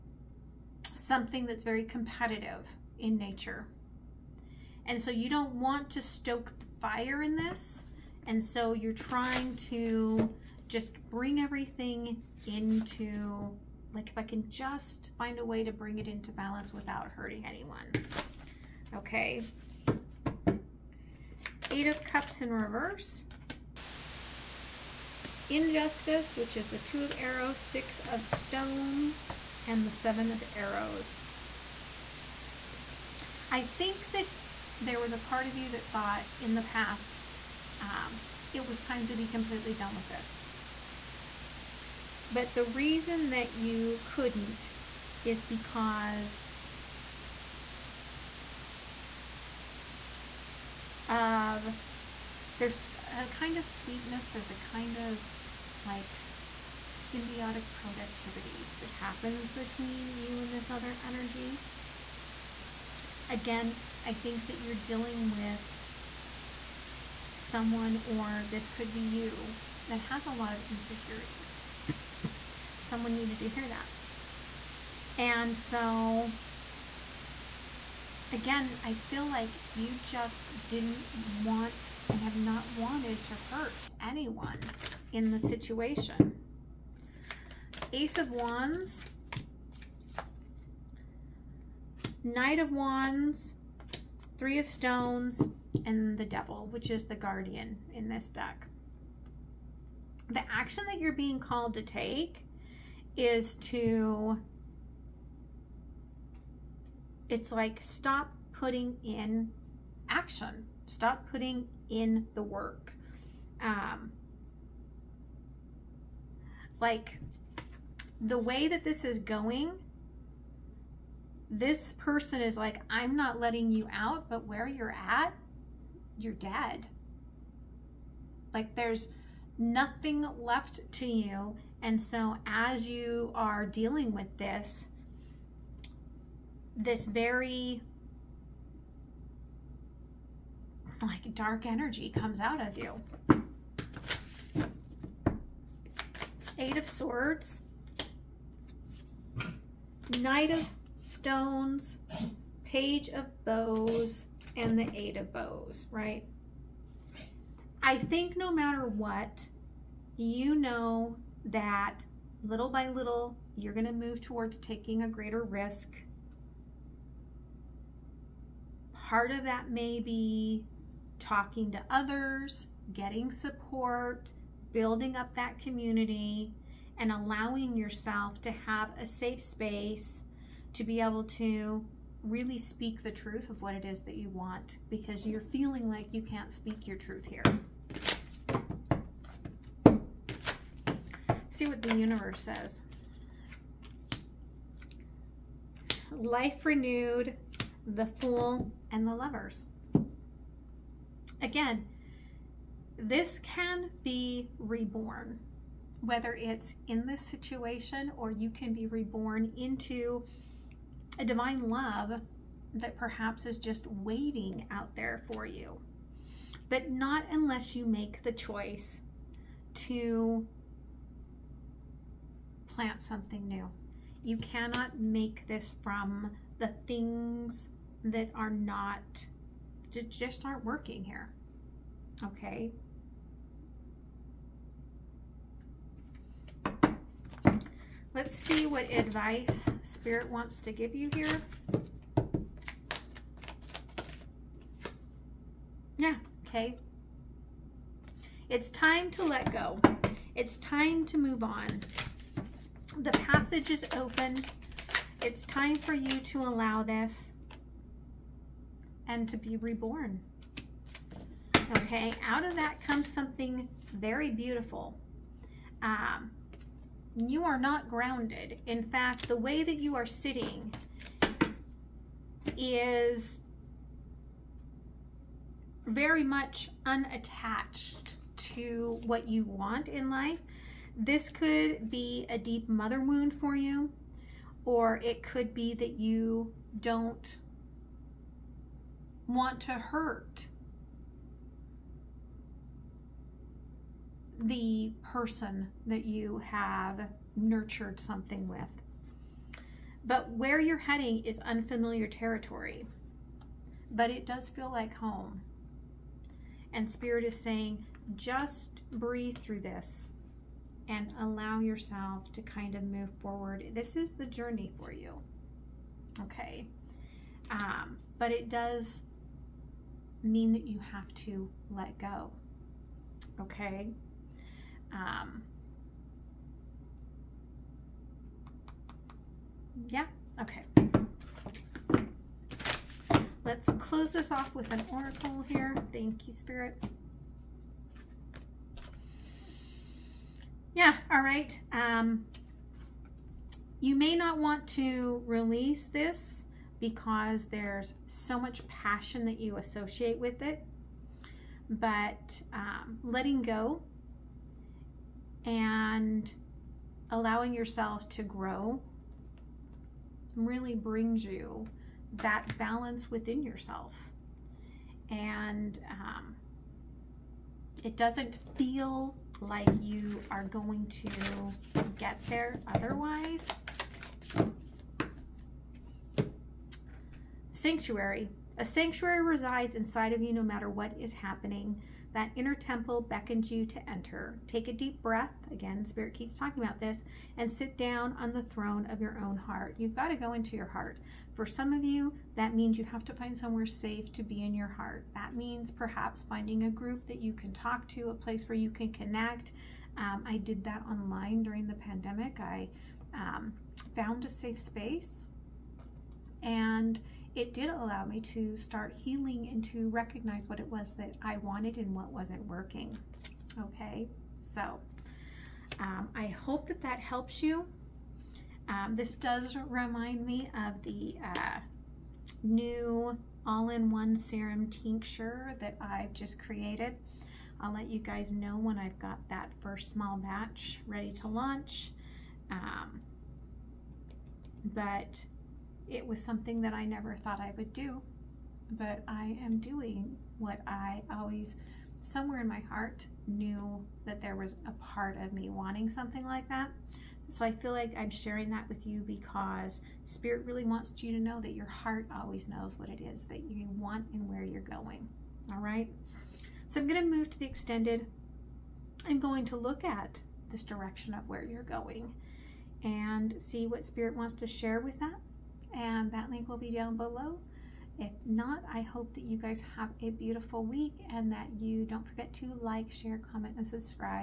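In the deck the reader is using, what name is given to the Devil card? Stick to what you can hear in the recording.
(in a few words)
The Guardian.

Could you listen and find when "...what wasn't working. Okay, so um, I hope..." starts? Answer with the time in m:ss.
6:51.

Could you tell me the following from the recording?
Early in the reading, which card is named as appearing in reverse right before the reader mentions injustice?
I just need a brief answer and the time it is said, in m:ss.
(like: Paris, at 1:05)
Eight of Cups, at 0:21.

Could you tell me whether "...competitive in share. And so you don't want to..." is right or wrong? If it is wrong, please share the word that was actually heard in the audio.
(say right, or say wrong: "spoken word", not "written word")
wrong: "nature", not "share".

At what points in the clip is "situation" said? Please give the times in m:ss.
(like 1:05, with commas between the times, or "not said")
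1:25, 3:27.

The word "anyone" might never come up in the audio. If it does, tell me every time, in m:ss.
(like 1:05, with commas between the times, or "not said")
0:17, 1:24.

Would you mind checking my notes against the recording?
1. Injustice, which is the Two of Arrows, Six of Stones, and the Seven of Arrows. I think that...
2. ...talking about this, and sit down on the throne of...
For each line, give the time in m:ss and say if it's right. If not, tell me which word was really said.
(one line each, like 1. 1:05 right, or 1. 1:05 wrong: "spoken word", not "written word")
1. 0:25 right
2. 6:26 right.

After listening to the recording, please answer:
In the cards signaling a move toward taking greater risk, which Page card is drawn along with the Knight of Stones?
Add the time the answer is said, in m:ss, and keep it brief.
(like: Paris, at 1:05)
Page of Bows, at 2:32.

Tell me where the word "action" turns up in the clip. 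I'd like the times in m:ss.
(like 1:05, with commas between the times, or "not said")
1:40, 1:50.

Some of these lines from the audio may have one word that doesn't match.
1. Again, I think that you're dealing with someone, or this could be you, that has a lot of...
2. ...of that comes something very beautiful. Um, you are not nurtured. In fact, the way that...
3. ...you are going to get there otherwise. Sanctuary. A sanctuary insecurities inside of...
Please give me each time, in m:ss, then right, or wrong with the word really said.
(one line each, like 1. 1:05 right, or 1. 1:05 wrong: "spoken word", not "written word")
1. 1:03 right
2. 4:22 wrong: "grounded", not "nurtured"
3. 6:09 wrong: "resides", not "insecurities".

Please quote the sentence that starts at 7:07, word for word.
I'll let you guys know when I've got that first small batch ready to launch.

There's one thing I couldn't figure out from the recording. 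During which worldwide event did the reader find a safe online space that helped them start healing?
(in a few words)
The pandemic.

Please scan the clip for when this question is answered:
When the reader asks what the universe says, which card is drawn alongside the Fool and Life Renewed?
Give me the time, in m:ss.
3:19.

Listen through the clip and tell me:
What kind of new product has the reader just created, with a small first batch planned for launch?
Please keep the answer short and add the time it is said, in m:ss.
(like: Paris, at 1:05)
All-in-one serum tincture, at 7:03.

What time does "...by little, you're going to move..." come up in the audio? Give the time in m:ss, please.
2:42.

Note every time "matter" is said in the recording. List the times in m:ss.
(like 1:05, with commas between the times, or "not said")
2:38, 6:20.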